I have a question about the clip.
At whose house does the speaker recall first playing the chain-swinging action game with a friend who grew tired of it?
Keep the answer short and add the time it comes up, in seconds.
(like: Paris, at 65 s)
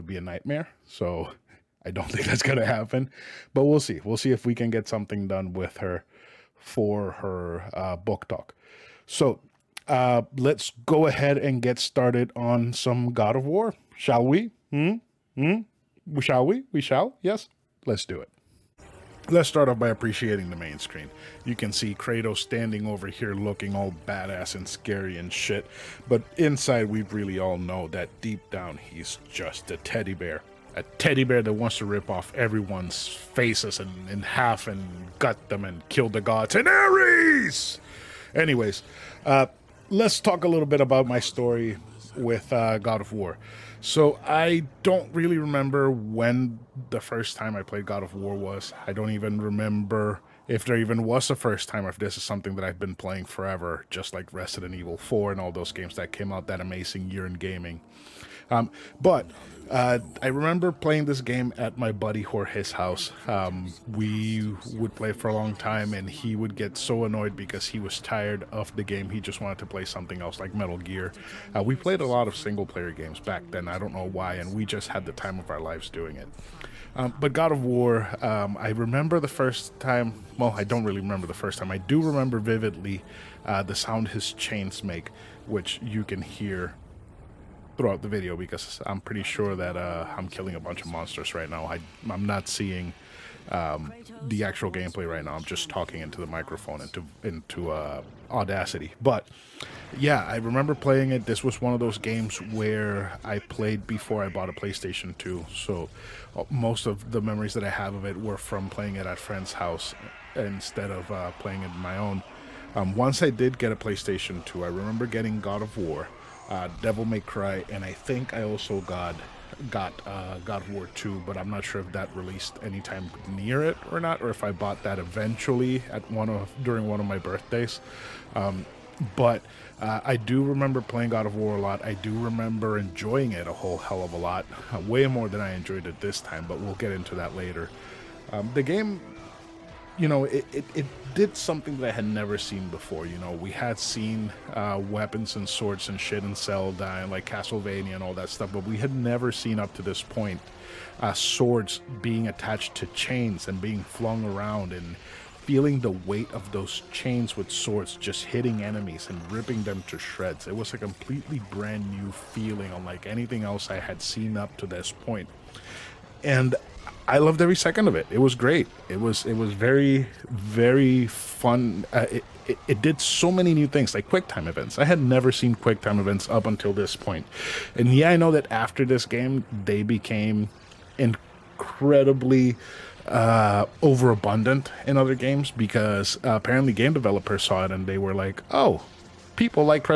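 Jorge, at 62 s.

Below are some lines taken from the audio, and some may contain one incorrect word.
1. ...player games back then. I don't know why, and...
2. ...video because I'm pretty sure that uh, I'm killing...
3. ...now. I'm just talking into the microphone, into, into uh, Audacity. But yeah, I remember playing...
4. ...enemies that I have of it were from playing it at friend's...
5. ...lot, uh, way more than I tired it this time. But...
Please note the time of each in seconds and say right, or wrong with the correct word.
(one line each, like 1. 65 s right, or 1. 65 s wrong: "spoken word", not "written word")
1. 72 s right
2. 88 s right
3. 95 s right
4. 107 s wrong: "memories", not "enemies"
5. 134 s wrong: "enjoyed", not "tired".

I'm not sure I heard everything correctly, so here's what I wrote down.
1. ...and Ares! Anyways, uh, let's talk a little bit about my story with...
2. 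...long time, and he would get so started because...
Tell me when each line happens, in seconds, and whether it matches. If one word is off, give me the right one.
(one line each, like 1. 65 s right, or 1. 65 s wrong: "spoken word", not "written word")
1. 36 s right
2. 65 s wrong: "annoyed", not "started".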